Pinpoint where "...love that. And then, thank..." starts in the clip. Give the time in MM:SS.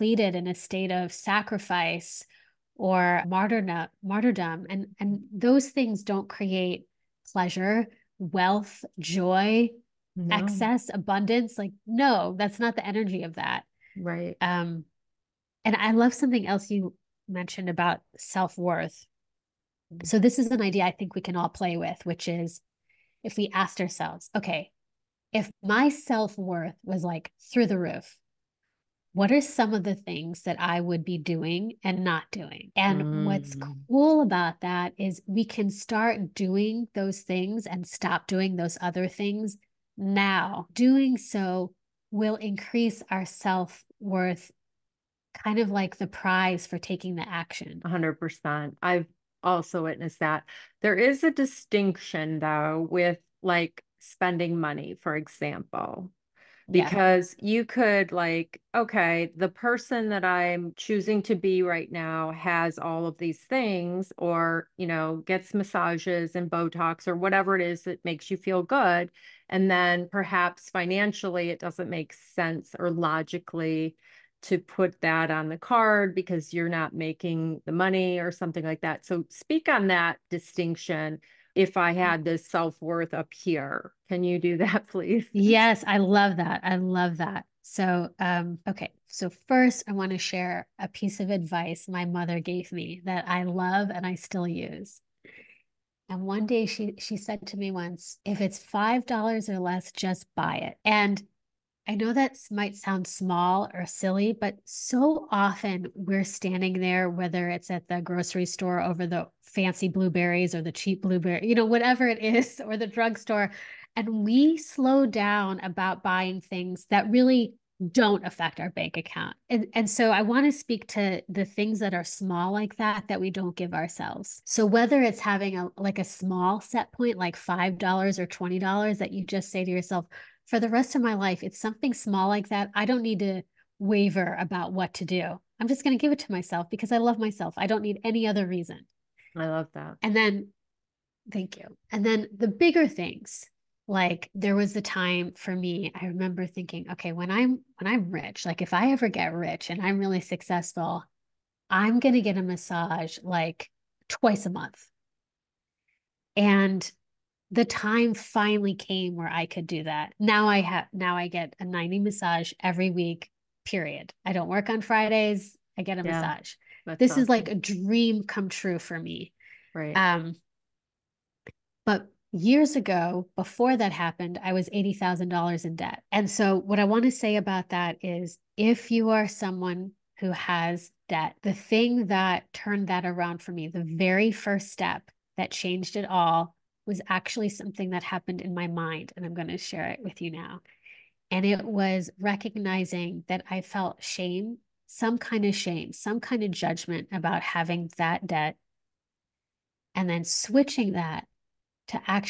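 02:19.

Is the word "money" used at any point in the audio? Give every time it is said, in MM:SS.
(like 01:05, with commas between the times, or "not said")
00:54, 01:17.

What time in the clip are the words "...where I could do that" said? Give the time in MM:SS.
02:39.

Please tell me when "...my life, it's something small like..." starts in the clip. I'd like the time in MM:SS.
02:11.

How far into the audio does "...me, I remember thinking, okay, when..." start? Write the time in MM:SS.
02:25.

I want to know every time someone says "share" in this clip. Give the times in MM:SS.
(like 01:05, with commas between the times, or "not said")
01:30, 03:09.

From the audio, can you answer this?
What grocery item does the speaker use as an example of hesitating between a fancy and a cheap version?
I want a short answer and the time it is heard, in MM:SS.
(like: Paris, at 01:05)
blueberries, at 01:49.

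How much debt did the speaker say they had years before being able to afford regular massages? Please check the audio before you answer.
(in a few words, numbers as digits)
$80,000.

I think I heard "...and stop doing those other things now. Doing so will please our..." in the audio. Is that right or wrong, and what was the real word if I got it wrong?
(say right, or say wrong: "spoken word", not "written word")
wrong: "increase", not "please".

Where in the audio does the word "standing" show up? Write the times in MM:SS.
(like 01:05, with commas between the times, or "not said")
01:46.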